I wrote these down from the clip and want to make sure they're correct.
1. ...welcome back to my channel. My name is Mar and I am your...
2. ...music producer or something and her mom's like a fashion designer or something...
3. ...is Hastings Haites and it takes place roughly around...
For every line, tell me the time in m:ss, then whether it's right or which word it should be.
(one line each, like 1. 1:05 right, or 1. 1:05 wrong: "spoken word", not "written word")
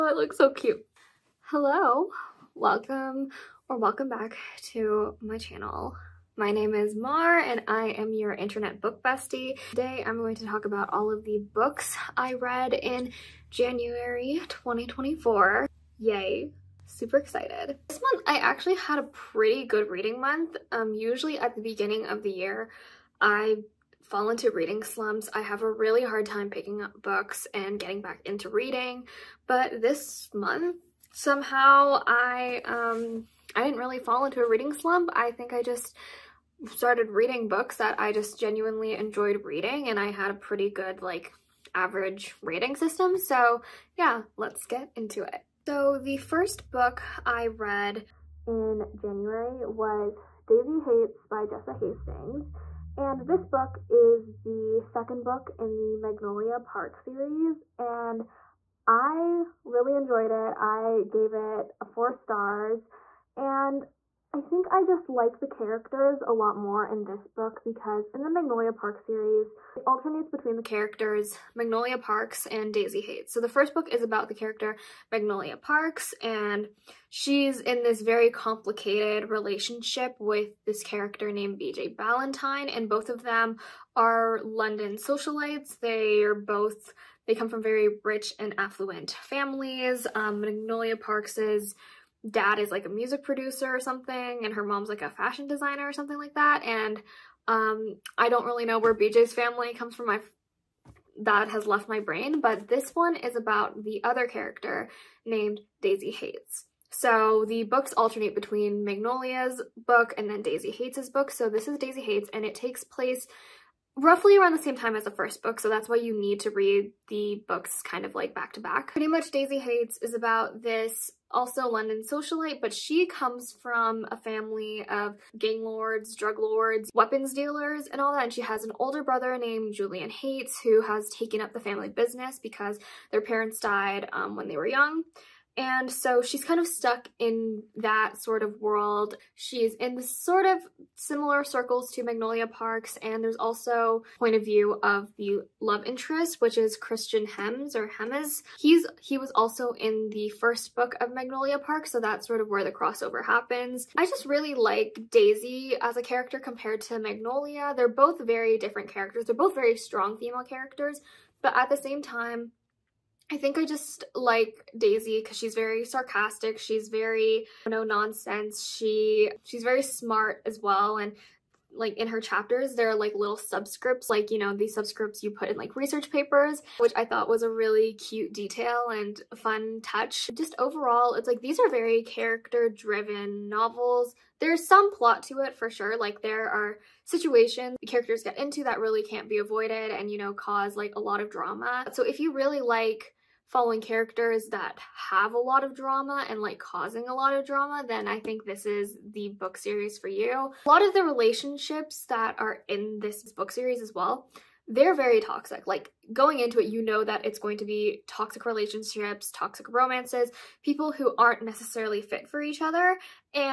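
1. 0:03 right
2. 1:32 right
3. 1:51 wrong: "Daisy", not "Hastings".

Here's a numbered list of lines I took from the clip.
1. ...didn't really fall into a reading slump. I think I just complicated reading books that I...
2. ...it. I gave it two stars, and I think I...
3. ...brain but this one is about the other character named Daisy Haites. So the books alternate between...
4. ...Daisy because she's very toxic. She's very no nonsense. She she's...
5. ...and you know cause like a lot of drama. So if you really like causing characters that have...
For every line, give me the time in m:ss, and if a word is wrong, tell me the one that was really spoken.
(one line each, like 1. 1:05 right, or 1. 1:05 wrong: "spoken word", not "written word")
1. 0:33 wrong: "started", not "complicated"
2. 1:00 wrong: "four", not "two"
3. 1:42 right
4. 2:44 wrong: "sarcastic", not "toxic"
5. 3:09 wrong: "following", not "causing".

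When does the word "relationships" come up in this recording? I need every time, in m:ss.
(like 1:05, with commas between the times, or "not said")
1:19, 3:21, 3:28.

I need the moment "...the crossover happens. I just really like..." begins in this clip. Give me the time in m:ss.
2:32.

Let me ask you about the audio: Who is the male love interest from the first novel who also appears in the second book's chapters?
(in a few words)
Christian Hems.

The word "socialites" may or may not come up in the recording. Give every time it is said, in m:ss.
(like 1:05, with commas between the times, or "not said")
1:24, 2:02.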